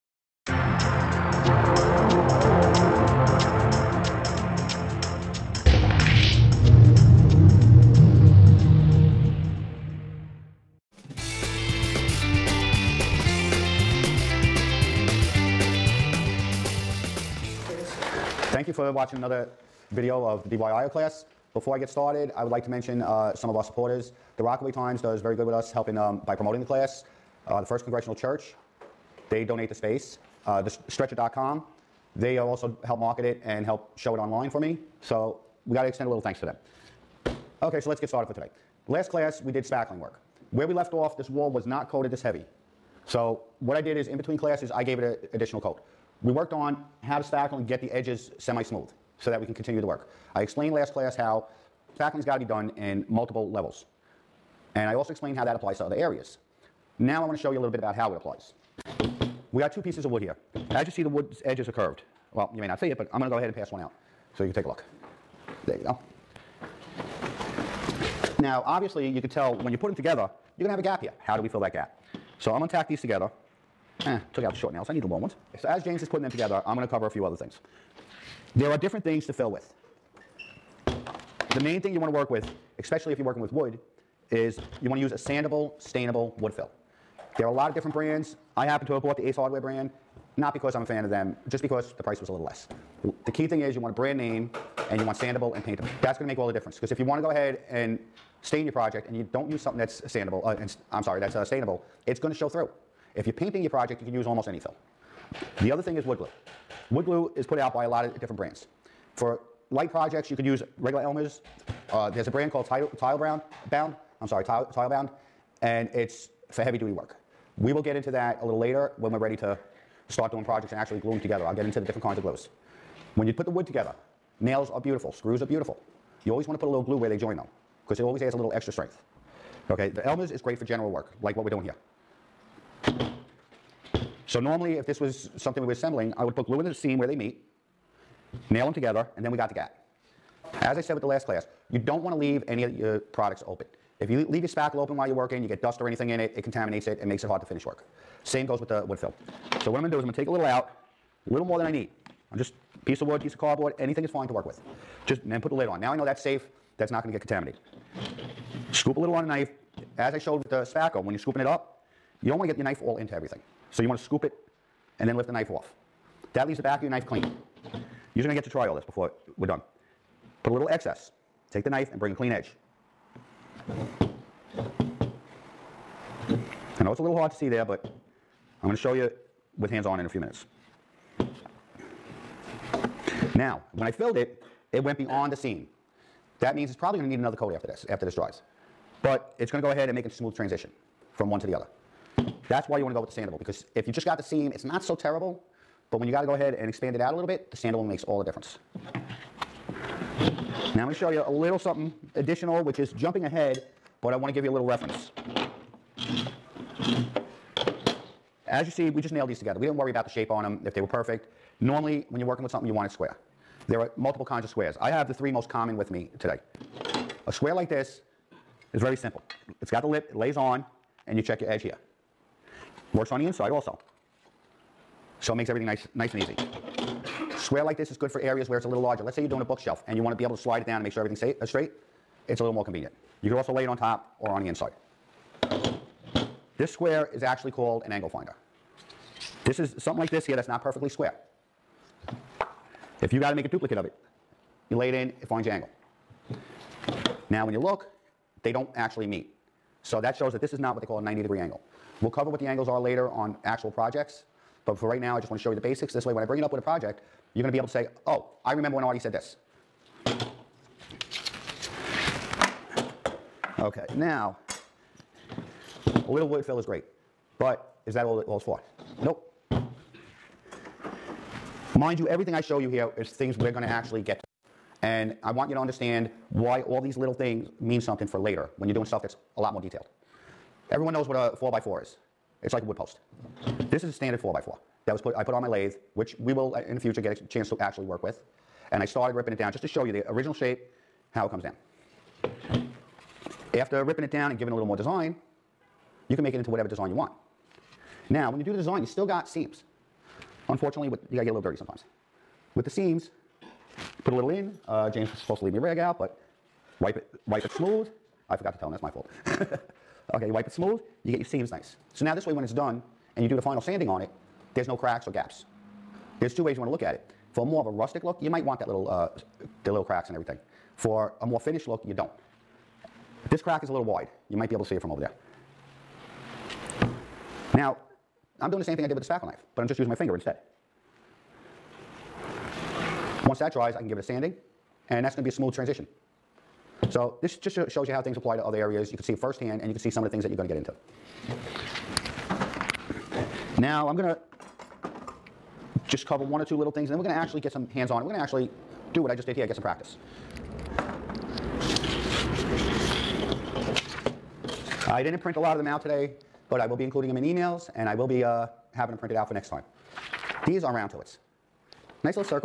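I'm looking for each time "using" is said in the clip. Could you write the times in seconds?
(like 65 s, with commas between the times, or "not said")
329 s.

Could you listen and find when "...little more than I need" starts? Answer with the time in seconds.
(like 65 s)
151 s.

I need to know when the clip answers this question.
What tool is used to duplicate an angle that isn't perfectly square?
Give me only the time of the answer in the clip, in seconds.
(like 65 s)
237 s.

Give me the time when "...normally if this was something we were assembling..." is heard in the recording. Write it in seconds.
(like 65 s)
134 s.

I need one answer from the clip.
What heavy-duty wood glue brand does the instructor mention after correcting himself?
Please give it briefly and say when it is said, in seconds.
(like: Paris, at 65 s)
Titebond, at 114 s.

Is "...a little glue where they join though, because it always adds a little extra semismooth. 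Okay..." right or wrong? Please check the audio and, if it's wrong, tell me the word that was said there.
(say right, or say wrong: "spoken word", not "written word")
wrong: "strength", not "semismooth".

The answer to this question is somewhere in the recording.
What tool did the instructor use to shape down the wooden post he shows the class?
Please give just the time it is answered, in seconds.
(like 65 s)
285 s.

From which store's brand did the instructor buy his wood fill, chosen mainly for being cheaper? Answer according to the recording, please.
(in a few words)
Ace Hardware.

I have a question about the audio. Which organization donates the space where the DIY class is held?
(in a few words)
First Congregational Church.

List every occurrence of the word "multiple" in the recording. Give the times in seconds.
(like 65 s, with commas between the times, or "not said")
53 s, 213 s.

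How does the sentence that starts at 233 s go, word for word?
You could also lay it on top or on the inside.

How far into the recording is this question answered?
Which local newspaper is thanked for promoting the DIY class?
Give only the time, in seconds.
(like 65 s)
24 s.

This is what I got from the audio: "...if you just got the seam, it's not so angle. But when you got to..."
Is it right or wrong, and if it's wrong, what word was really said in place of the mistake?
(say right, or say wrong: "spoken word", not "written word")
wrong: "terrible", not "angle".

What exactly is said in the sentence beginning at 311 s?
So now this way when it's done and you do the final sanding on it, there's no cracks or gaps.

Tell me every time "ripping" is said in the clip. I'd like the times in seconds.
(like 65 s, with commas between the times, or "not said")
289 s, 293 s.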